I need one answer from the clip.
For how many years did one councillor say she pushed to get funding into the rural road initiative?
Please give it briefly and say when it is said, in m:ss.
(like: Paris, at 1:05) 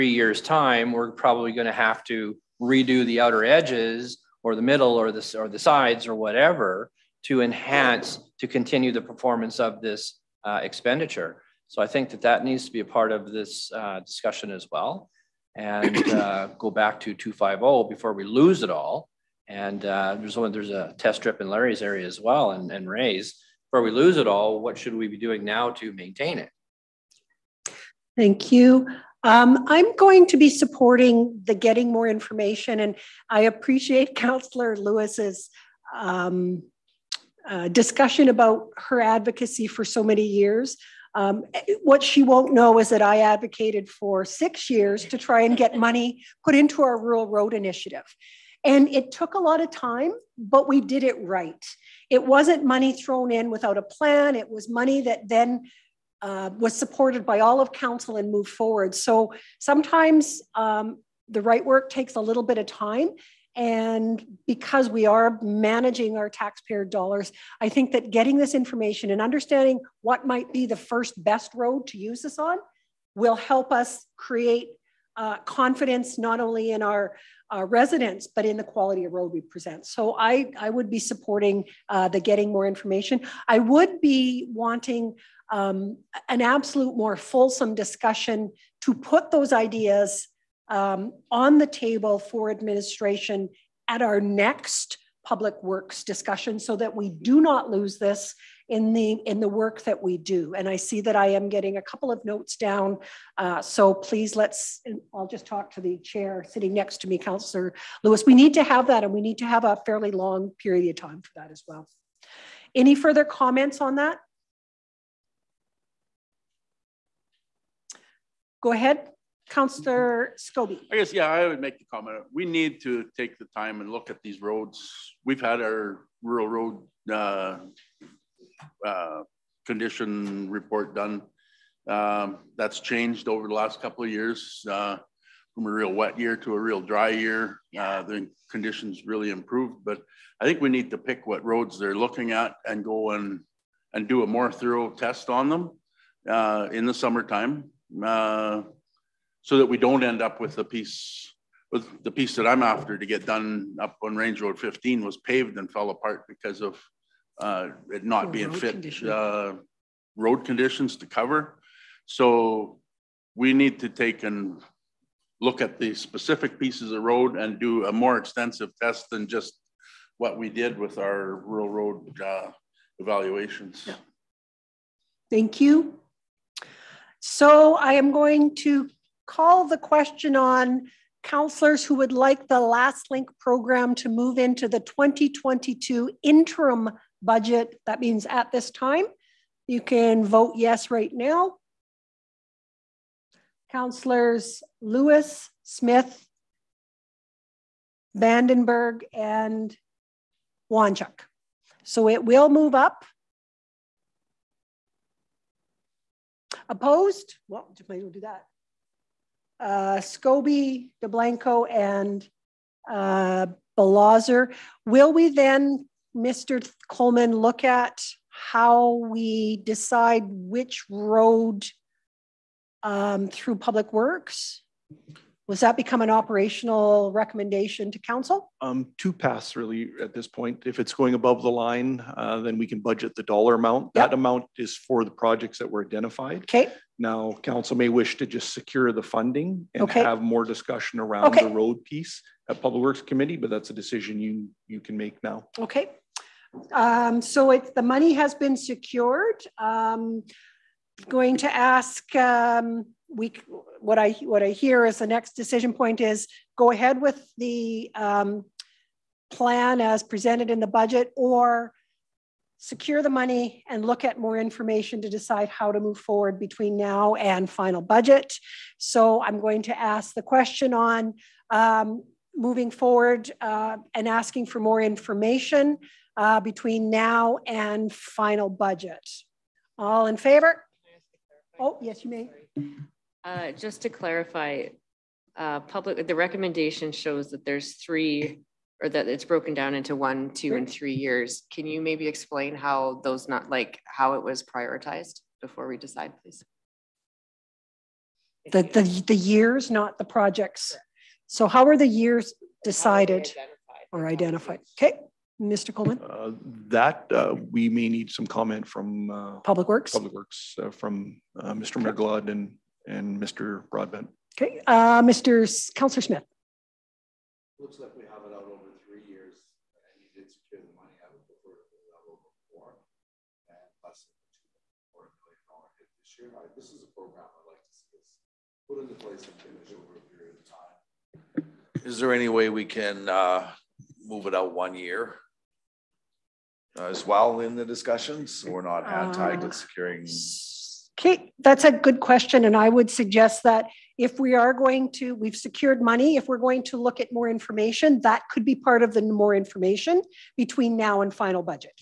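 6, at 0:44.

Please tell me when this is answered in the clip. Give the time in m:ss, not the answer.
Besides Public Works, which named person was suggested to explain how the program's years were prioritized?
5:13.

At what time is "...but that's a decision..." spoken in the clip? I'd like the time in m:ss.
4:03.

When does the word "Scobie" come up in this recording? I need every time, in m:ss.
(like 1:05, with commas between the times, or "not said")
2:00, 3:29.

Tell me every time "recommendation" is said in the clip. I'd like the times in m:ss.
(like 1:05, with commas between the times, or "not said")
3:47, 4:46.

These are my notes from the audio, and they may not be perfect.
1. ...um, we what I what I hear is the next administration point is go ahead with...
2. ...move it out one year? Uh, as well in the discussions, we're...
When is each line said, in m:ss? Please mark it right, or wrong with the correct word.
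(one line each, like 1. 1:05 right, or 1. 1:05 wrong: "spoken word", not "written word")
1. 4:12 wrong: "decision", not "administration"
2. 5:34 right.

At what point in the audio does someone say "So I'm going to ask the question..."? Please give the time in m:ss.
4:28.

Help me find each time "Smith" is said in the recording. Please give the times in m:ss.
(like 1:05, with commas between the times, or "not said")
3:15, 5:16.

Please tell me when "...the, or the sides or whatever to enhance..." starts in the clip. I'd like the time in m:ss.
0:05.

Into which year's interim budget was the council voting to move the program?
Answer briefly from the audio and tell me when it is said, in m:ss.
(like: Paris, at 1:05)
2022, at 3:04.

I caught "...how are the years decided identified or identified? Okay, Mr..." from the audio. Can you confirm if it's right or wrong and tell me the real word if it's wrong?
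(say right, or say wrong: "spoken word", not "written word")
right.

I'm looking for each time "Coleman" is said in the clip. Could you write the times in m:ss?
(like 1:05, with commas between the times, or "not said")
3:36, 5:05.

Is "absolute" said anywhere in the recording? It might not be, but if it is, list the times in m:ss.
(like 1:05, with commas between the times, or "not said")
1:26.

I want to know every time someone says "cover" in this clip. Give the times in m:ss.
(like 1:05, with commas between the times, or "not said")
2:41.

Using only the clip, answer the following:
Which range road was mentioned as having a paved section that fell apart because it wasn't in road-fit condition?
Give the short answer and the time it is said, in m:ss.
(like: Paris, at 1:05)
Range Road 15, at 2:34.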